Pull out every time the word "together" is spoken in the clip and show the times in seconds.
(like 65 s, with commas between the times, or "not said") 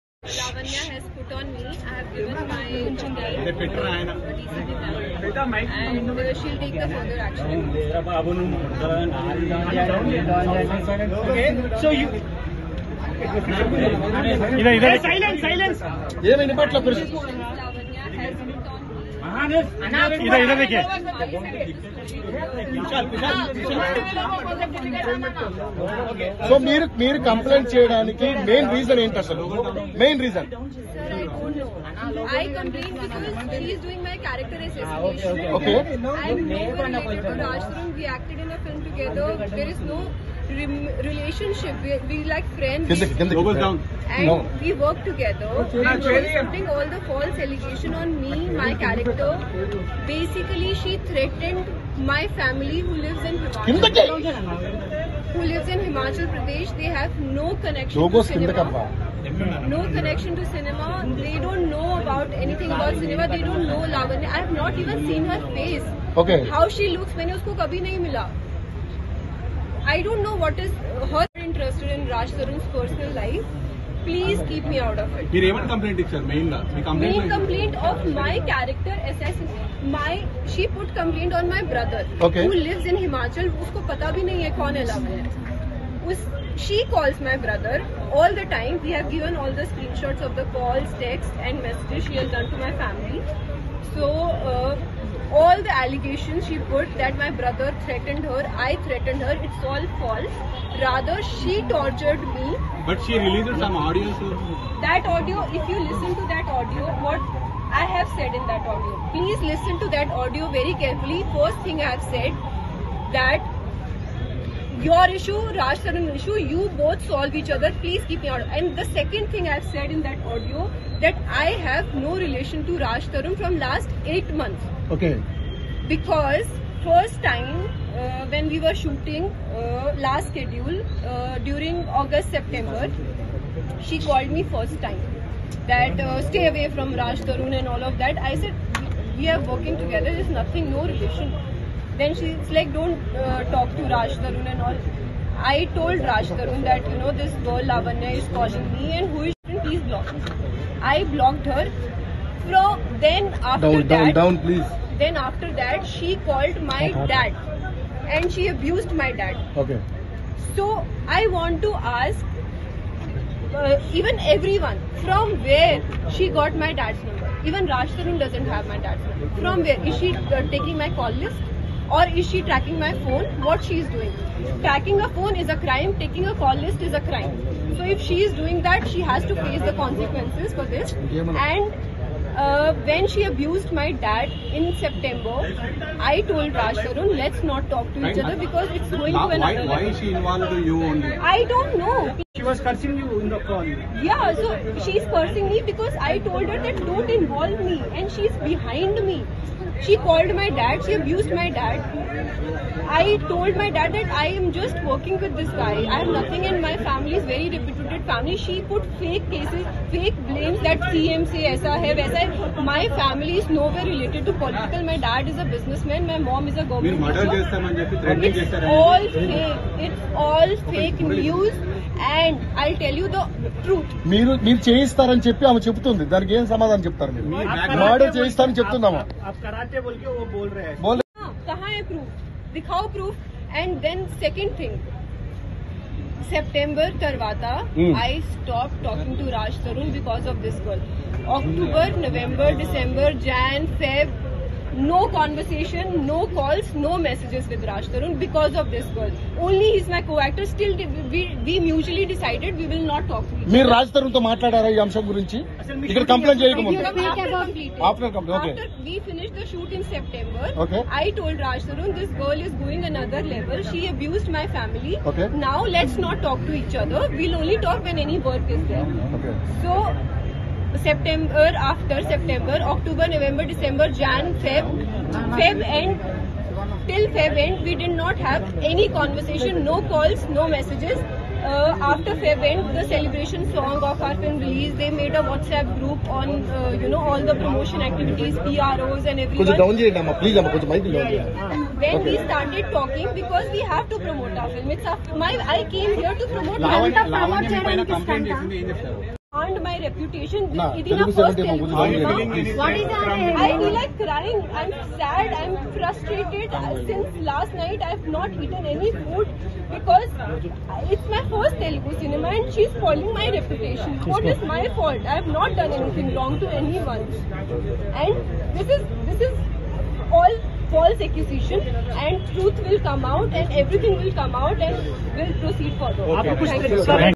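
45 s, 139 s.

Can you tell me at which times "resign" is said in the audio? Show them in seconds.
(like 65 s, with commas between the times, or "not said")
not said.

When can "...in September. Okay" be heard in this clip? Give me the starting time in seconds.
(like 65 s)
259 s.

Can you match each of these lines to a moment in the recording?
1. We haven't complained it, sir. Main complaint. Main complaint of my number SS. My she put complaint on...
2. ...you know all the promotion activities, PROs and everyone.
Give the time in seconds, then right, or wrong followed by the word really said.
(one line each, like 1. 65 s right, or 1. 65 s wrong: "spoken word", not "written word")
1. 75 s wrong: "character", not "number"
2. 286 s right.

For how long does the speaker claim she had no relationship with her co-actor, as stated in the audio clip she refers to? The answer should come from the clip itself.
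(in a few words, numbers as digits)
8 months.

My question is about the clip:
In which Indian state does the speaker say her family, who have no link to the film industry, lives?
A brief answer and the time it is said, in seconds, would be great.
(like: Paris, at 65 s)
Himachal Pradesh, at 55 s.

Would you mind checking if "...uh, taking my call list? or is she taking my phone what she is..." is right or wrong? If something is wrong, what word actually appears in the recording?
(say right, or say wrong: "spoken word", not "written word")
wrong: "tracking", not "taking".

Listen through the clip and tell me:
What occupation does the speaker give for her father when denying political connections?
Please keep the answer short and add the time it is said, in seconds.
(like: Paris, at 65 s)
businessman, at 215 s.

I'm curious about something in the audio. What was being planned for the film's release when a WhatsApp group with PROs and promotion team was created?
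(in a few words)
celebration song.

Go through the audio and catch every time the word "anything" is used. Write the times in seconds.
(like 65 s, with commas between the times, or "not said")
62 s, 315 s.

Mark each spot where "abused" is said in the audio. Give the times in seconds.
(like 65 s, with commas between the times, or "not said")
158 s, 183 s, 200 s, 263 s.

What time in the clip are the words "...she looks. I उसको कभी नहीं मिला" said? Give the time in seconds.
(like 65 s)
66 s.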